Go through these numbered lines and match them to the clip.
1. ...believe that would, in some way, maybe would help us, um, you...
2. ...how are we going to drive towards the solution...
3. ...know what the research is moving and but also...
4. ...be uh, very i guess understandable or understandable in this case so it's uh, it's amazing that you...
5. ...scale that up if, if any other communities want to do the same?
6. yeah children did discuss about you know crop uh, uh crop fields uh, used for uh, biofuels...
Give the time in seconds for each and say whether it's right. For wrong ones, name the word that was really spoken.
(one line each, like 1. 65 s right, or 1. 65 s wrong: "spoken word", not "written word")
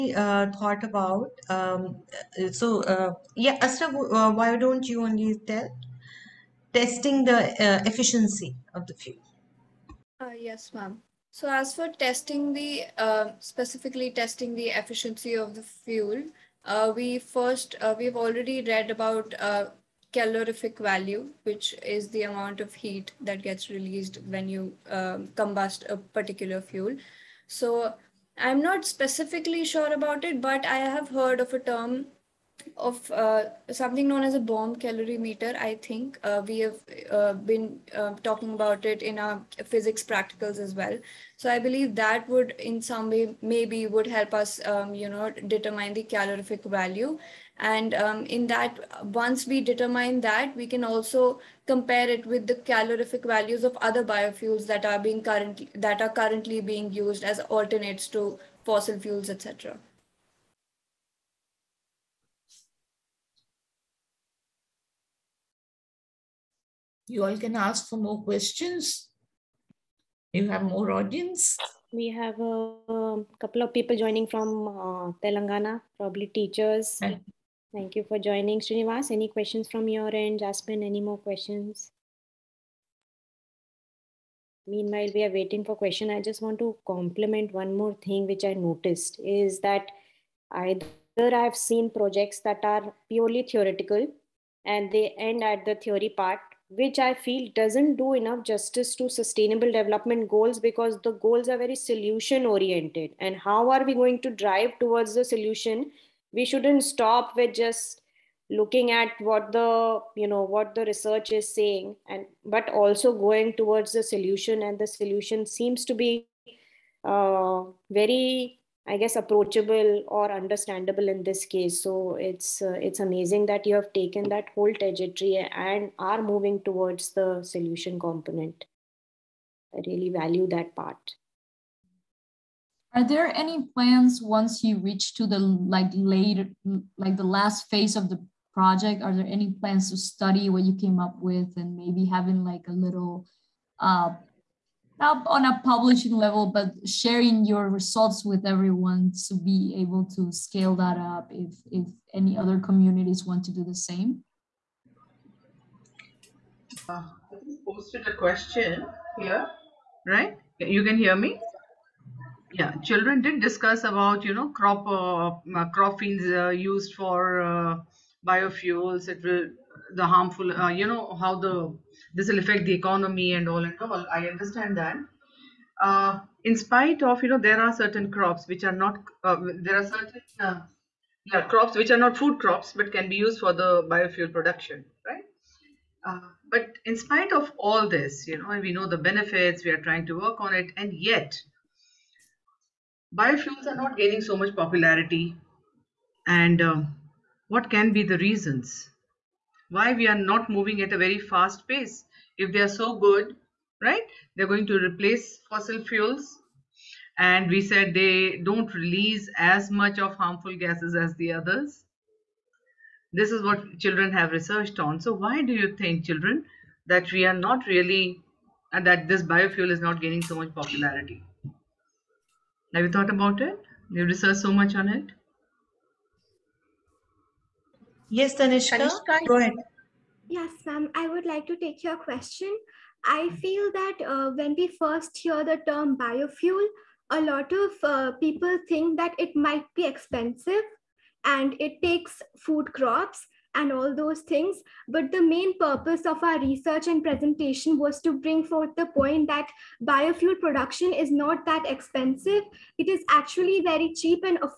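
1. 41 s right
2. 103 s right
3. 110 s wrong: "saying", not "moving"
4. 116 s wrong: "approachable", not "understandable"
5. 150 s right
6. 162 s right.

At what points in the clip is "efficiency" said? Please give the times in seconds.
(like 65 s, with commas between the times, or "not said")
7 s, 14 s.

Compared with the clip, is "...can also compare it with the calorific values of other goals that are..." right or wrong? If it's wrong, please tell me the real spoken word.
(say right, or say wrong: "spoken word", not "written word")
wrong: "biofuels", not "goals".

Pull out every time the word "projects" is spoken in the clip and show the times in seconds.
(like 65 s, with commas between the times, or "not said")
91 s, 138 s.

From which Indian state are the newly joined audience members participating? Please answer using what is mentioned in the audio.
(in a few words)
Telangana.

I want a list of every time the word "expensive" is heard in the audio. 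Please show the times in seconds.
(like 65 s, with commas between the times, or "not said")
239 s, 251 s.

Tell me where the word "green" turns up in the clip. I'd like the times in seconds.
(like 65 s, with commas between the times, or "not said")
not said.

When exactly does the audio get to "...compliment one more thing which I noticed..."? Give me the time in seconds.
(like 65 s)
86 s.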